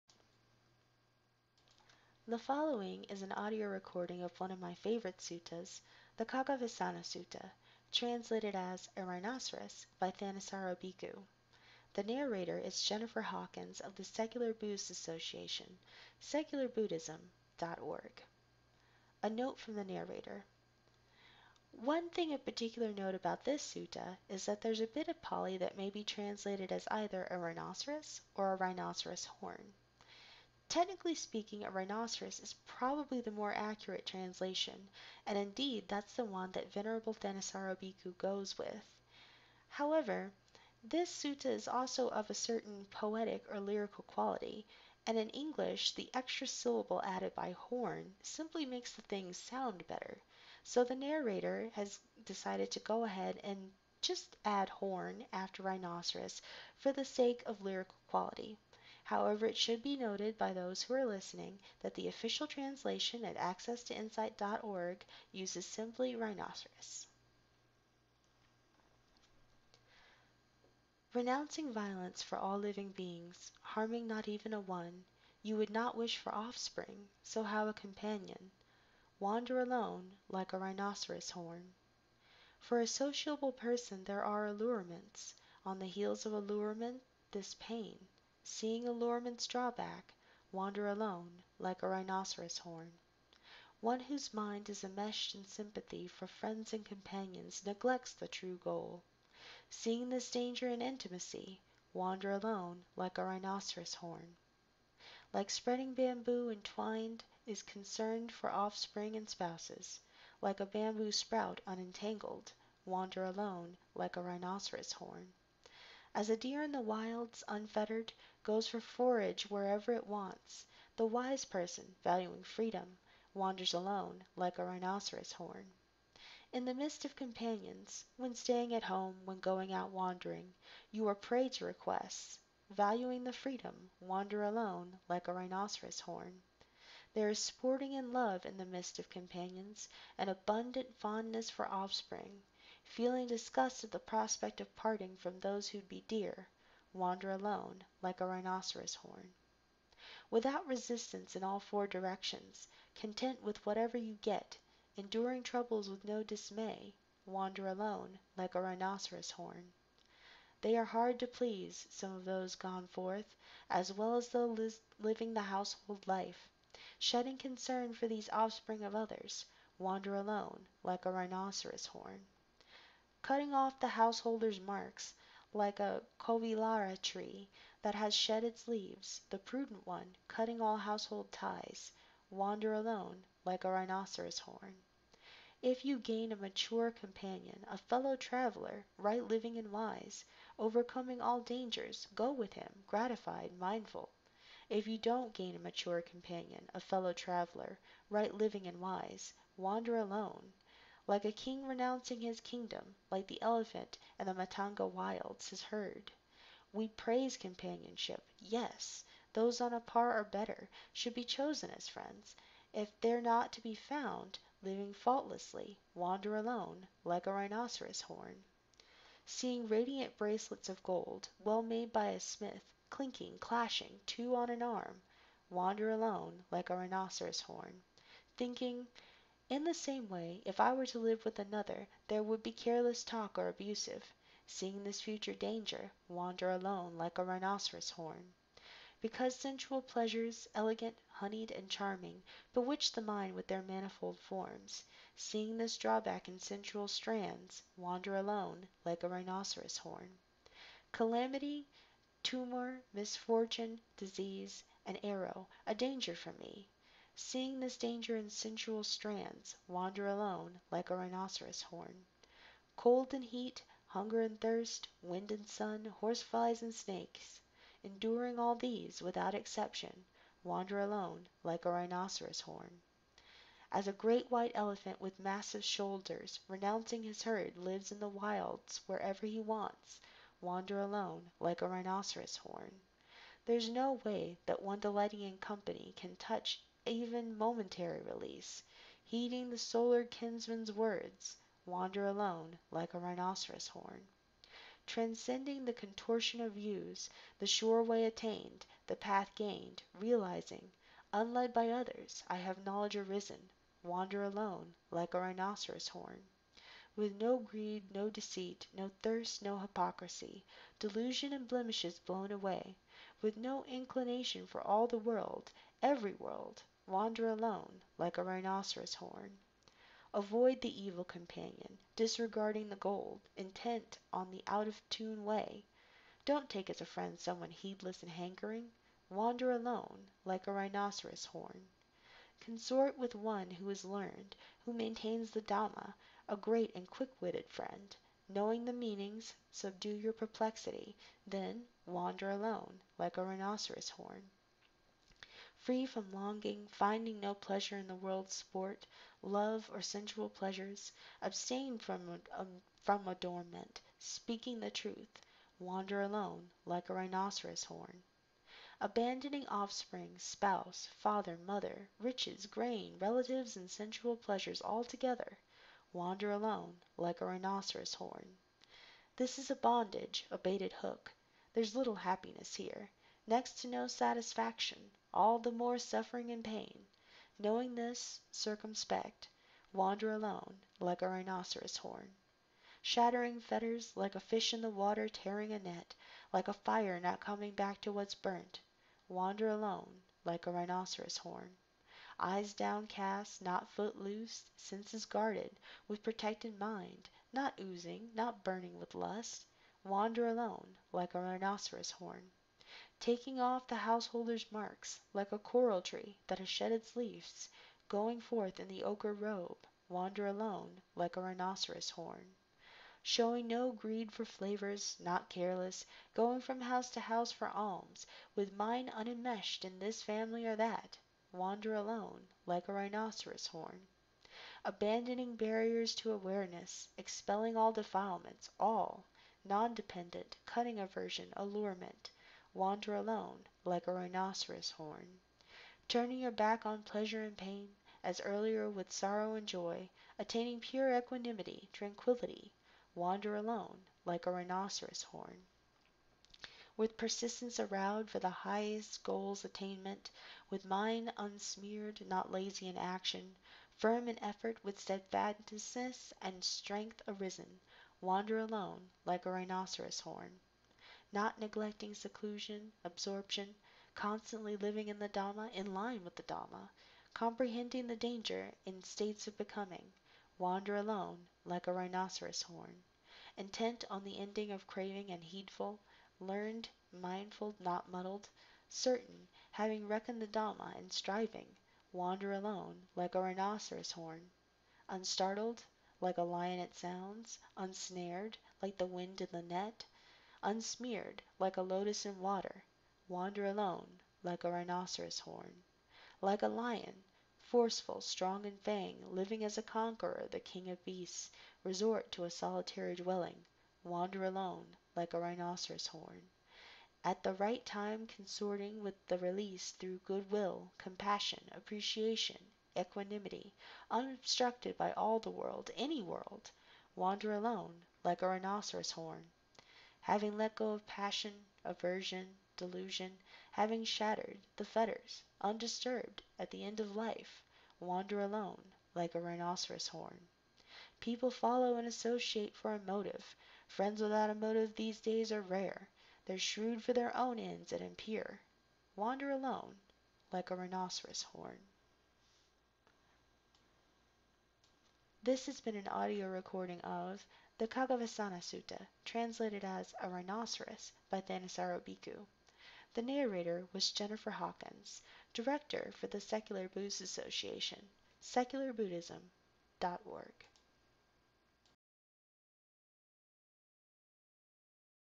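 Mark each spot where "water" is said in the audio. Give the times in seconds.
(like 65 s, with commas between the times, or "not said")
384 s, 492 s.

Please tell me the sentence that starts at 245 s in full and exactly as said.
Seeing this drawback in sensual strands, wander alone like a rhinoceros horn.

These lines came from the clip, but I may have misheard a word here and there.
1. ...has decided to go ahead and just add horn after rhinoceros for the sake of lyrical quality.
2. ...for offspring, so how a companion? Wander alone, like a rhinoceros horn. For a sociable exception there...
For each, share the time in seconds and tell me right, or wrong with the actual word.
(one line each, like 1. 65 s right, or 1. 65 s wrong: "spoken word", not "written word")
1. 51 s right
2. 76 s wrong: "person", not "exception".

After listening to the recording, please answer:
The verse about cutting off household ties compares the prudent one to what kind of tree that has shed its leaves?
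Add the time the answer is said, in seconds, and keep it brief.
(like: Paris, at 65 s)
koviḷāra tree, at 176 s.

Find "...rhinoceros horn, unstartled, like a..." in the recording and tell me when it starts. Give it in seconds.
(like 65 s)
483 s.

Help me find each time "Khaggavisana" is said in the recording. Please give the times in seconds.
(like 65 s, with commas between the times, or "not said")
6 s, 547 s.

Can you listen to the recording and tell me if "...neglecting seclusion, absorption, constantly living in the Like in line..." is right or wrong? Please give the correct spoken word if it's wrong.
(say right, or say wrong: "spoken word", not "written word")
wrong: "Dhamma", not "Like".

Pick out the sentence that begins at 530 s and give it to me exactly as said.
People follow and associate for a motive.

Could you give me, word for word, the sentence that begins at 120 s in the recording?
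The wise person, valuing freedom, wanders alone like a rhinoceros horn.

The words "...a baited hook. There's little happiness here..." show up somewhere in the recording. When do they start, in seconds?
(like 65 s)
370 s.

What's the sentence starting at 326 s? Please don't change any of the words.
Don't take as a friend someone heedless and hankering.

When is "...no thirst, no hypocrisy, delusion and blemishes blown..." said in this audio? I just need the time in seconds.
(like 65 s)
308 s.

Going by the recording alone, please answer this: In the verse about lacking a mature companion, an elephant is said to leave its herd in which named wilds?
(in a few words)
Matanga.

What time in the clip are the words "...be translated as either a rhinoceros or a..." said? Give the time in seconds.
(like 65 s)
25 s.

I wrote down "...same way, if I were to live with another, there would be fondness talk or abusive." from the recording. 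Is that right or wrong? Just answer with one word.
wrong.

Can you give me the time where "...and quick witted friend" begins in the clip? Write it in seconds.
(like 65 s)
336 s.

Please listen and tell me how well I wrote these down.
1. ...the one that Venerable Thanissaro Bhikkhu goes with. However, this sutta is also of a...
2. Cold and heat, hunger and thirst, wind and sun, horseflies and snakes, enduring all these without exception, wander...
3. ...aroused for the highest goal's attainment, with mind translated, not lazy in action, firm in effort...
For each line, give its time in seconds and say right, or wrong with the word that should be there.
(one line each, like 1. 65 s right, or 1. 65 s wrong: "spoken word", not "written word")
1. 36 s right
2. 262 s right
3. 447 s wrong: "unsmeared", not "translated".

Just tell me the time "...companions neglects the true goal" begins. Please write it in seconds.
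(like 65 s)
96 s.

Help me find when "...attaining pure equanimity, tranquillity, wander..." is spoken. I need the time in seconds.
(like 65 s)
440 s.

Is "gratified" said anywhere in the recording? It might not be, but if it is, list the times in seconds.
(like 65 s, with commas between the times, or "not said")
192 s.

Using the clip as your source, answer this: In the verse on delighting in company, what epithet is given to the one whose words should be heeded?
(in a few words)
the solar kinsman.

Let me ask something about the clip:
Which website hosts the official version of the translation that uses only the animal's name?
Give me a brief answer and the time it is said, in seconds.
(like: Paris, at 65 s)
accesstoinsight.org, at 63 s.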